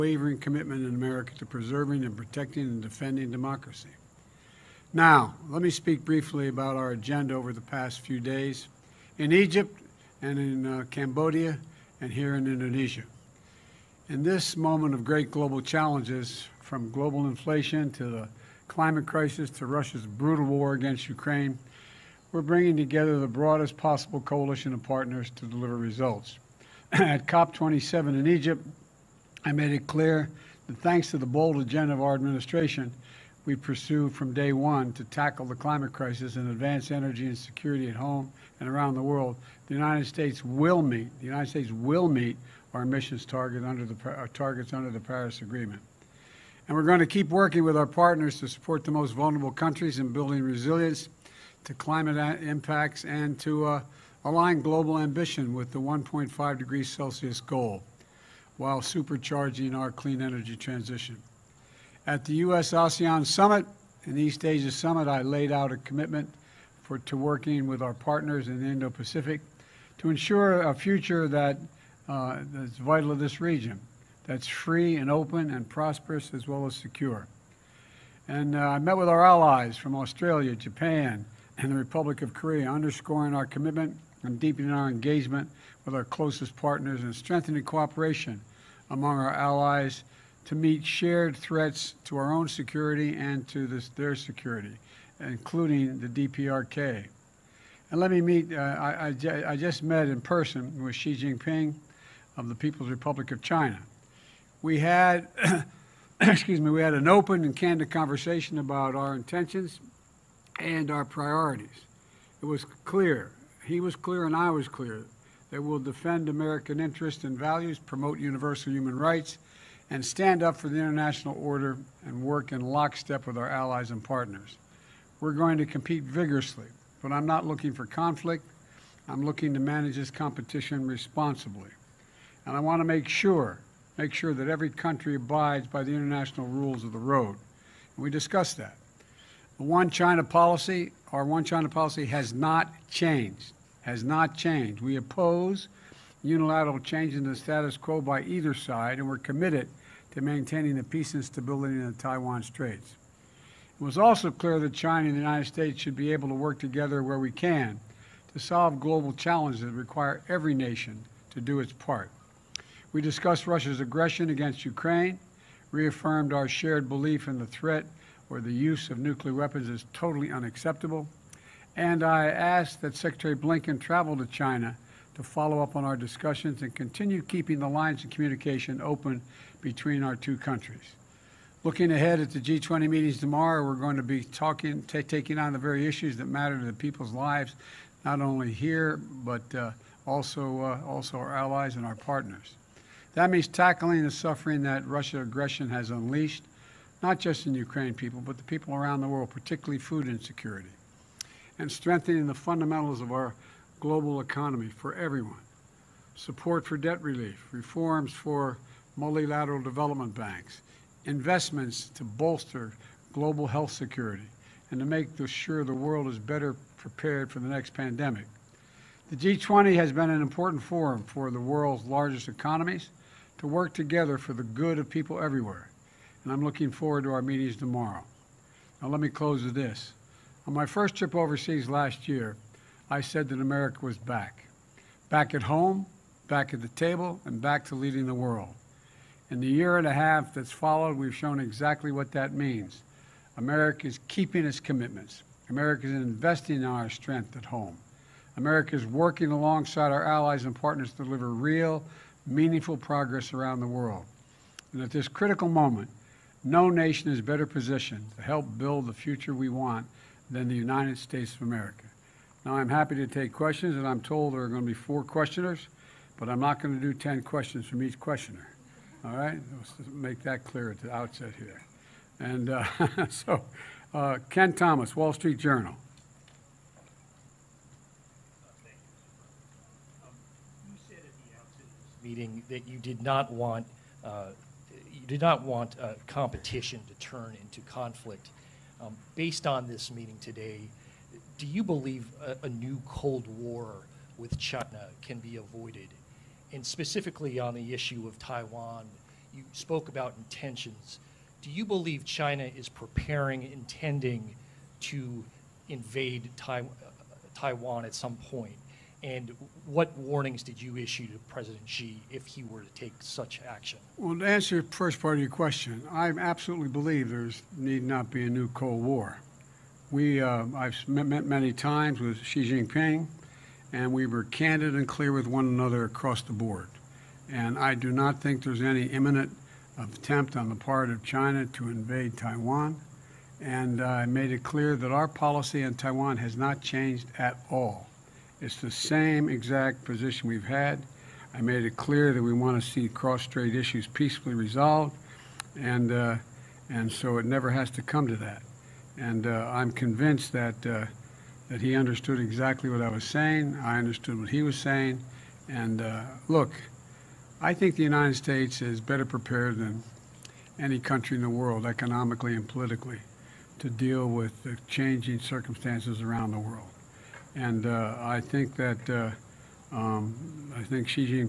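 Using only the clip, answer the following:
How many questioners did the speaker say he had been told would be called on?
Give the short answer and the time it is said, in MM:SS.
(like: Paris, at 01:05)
4, at 04:24.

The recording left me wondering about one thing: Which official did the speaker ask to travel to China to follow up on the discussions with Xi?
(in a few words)
Secretary Blinken.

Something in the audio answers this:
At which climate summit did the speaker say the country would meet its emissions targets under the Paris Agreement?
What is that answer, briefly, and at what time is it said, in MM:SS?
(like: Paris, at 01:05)
COP27, at 00:27.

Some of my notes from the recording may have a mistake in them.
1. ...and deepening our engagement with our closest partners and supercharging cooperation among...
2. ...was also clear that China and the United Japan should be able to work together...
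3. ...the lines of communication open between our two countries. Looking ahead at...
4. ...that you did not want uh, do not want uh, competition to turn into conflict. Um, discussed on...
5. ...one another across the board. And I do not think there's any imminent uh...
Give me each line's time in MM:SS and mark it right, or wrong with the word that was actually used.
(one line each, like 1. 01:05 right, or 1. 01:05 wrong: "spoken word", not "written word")
1. 01:24 wrong: "strengthening", not "supercharging"
2. 02:33 wrong: "States", not "Japan"
3. 02:57 right
4. 04:42 wrong: "based", not "discussed"
5. 05:25 right.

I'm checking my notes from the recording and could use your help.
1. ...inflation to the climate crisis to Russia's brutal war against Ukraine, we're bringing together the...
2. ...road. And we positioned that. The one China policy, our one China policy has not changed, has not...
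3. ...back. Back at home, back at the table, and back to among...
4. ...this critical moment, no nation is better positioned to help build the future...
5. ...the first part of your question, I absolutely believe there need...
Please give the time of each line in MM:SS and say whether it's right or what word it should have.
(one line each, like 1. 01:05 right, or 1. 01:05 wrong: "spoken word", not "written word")
1. 00:17 right
2. 02:16 wrong: "discussed", not "positioned"
3. 03:53 wrong: "leading", not "among"
4. 04:14 right
5. 05:14 right.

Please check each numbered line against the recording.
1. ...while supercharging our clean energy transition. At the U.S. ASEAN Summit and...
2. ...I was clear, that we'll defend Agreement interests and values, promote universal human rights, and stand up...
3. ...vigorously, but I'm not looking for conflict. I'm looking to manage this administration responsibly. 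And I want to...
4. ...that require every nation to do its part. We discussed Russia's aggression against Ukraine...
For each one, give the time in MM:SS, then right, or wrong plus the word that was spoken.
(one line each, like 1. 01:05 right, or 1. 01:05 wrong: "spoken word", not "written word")
1. 00:58 right
2. 01:54 wrong: "American", not "Agreement"
3. 02:06 wrong: "competition", not "administration"
4. 02:39 right.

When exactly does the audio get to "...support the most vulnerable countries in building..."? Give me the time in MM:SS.
00:48.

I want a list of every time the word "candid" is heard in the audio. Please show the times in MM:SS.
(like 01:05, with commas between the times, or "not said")
01:47, 05:24.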